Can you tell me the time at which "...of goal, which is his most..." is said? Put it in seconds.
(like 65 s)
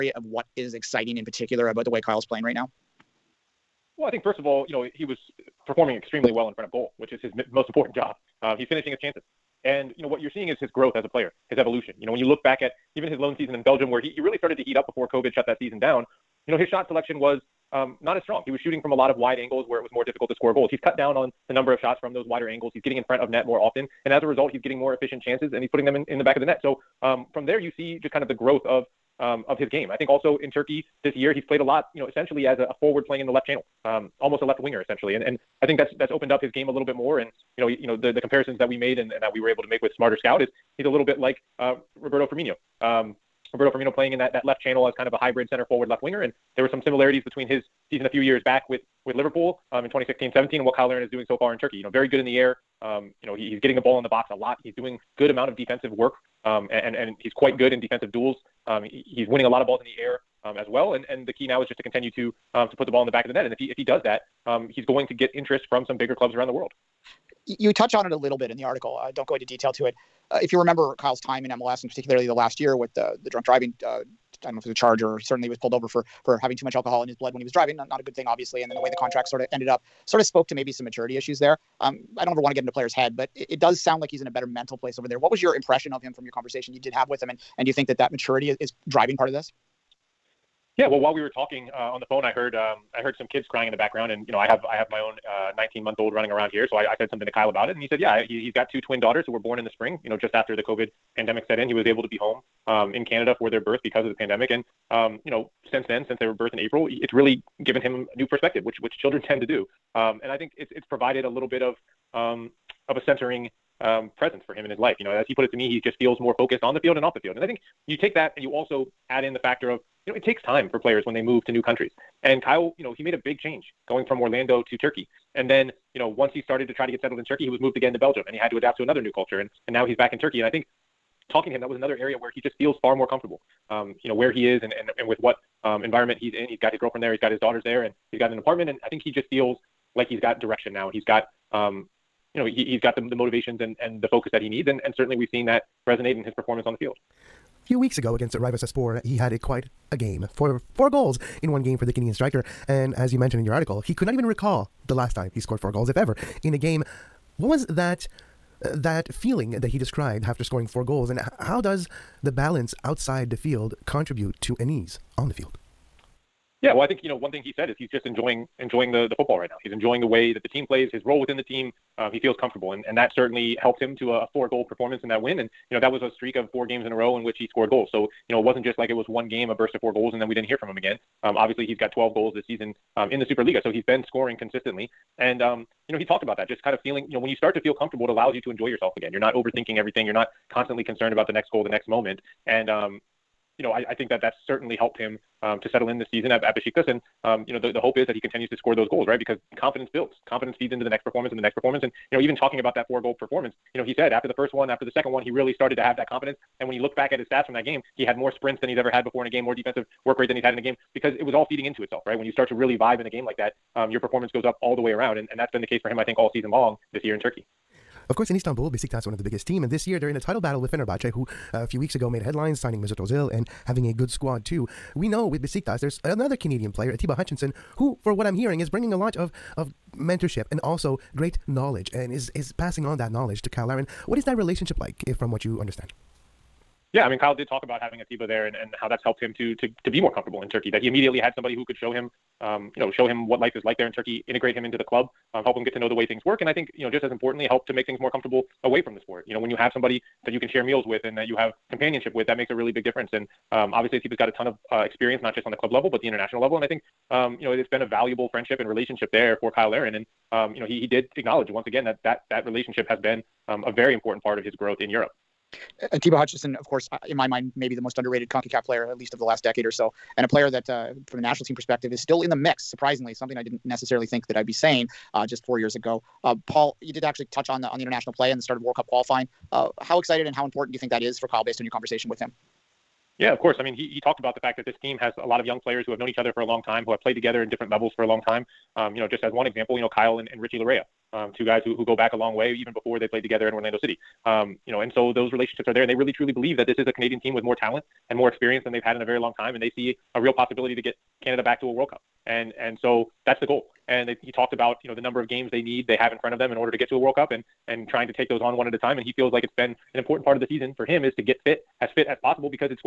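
6 s.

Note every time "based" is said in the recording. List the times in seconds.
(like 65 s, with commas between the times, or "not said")
281 s.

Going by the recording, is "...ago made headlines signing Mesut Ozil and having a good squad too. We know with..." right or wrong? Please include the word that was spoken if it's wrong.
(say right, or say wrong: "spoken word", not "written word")
right.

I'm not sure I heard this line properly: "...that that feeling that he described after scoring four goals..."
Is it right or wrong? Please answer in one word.
right.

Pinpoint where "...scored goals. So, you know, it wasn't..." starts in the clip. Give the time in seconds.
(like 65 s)
177 s.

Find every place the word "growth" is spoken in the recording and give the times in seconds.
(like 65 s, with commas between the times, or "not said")
10 s, 28 s, 264 s.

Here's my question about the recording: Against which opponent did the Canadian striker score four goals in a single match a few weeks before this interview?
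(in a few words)
Rizespor.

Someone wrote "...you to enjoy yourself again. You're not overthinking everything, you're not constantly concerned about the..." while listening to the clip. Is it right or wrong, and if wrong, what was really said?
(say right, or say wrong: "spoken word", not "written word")
right.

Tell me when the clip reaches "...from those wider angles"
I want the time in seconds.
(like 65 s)
22 s.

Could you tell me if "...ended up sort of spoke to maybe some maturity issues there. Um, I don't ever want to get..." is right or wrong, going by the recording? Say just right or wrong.
right.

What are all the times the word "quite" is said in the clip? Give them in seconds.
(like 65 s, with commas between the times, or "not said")
57 s, 149 s.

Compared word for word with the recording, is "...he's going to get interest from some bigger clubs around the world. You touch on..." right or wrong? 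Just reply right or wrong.
right.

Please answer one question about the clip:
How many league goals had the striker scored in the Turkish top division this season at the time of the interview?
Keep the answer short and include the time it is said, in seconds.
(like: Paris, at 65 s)
12, at 181 s.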